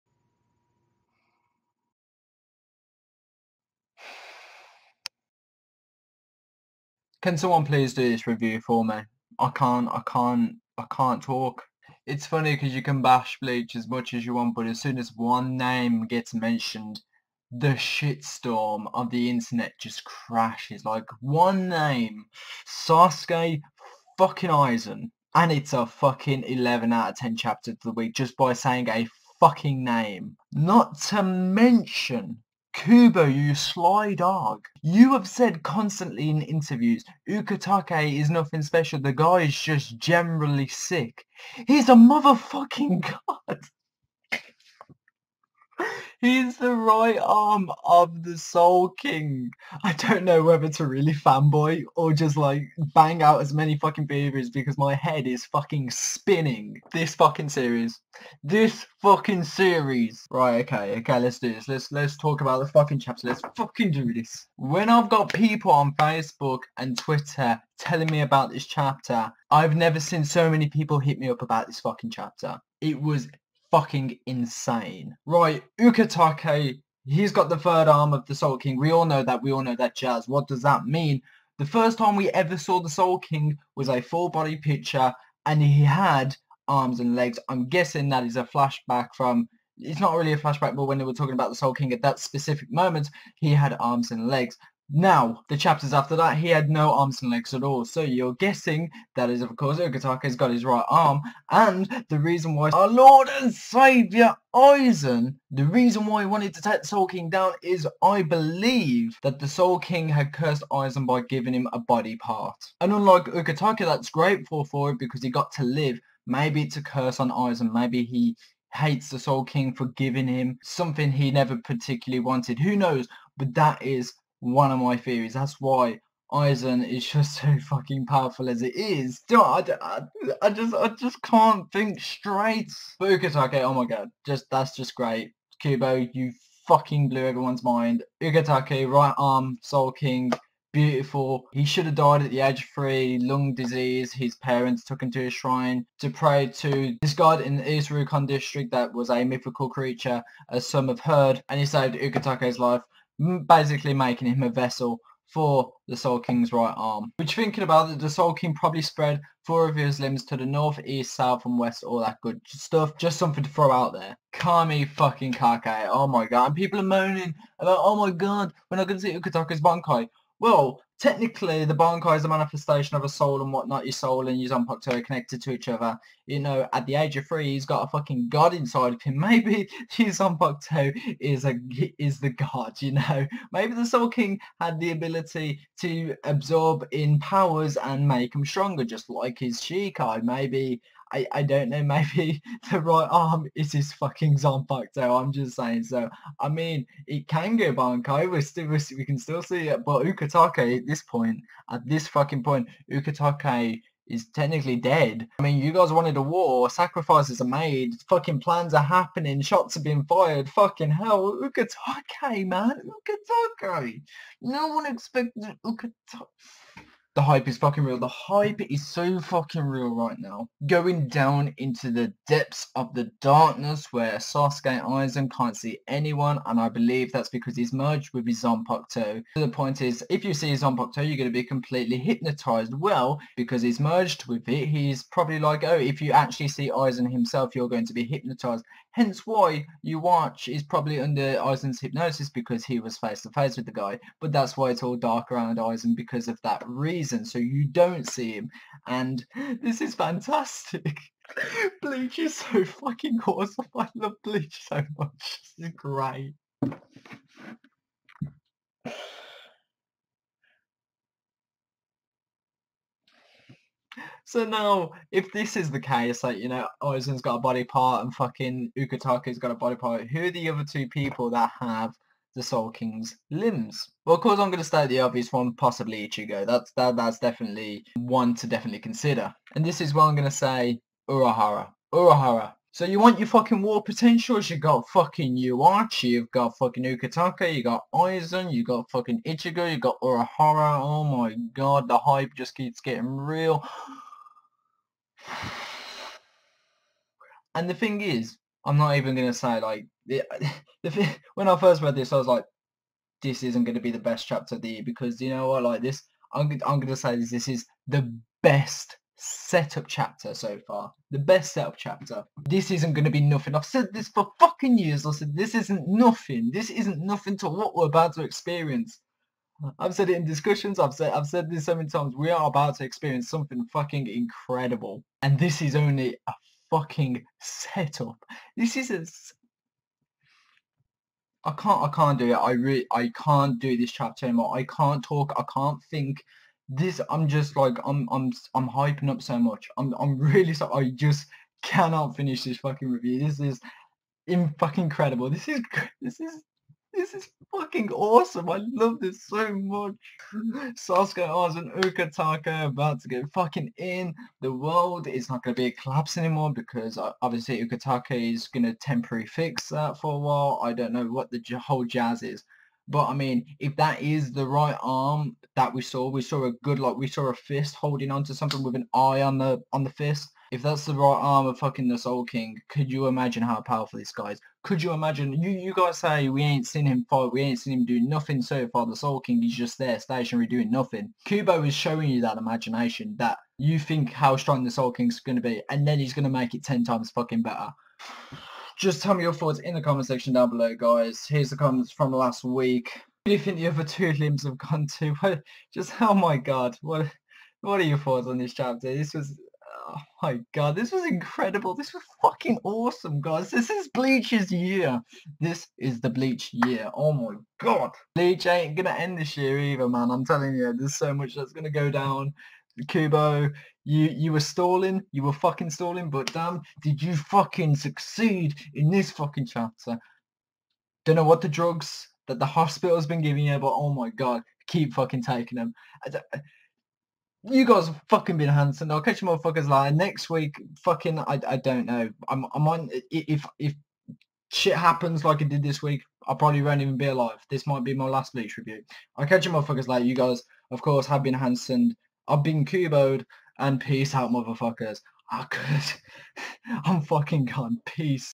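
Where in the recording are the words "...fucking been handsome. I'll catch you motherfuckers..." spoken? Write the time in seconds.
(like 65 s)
428 s.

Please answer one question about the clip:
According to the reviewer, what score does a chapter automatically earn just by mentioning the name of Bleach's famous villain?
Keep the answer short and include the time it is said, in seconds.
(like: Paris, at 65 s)
11 out of 10, at 26 s.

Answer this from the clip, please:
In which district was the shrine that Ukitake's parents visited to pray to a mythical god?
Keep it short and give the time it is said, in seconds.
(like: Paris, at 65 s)
East Rukon district, at 147 s.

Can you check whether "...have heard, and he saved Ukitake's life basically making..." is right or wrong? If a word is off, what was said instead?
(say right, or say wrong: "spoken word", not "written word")
right.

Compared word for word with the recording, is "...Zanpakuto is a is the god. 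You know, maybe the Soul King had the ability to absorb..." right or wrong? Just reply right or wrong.
right.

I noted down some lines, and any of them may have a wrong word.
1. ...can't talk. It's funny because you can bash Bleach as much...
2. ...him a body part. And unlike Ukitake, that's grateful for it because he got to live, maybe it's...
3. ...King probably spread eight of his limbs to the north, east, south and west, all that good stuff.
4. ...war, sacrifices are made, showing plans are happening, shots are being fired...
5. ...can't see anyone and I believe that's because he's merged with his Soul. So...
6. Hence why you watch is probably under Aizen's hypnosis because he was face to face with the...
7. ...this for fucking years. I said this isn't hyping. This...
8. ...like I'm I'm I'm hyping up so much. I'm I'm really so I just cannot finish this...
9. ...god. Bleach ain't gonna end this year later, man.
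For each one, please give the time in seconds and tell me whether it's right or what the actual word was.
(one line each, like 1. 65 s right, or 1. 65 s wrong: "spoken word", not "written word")
1. 10 s right
2. 111 s right
3. 158 s wrong: "four", not "eight"
4. 206 s wrong: "fucking", not "showing"
5. 225 s wrong: "Zanpakuto", not "Soul"
6. 238 s right
7. 313 s wrong: "nothing", not "hyping"
8. 337 s right
9. 407 s wrong: "either", not "later".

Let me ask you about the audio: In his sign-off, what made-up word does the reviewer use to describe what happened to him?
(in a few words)
kuboed.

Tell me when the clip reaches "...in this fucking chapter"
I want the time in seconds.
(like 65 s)
418 s.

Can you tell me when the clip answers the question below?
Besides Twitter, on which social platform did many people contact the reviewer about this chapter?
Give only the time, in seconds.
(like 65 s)
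65 s.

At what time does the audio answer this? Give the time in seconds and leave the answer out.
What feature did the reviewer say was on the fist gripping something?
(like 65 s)
368 s.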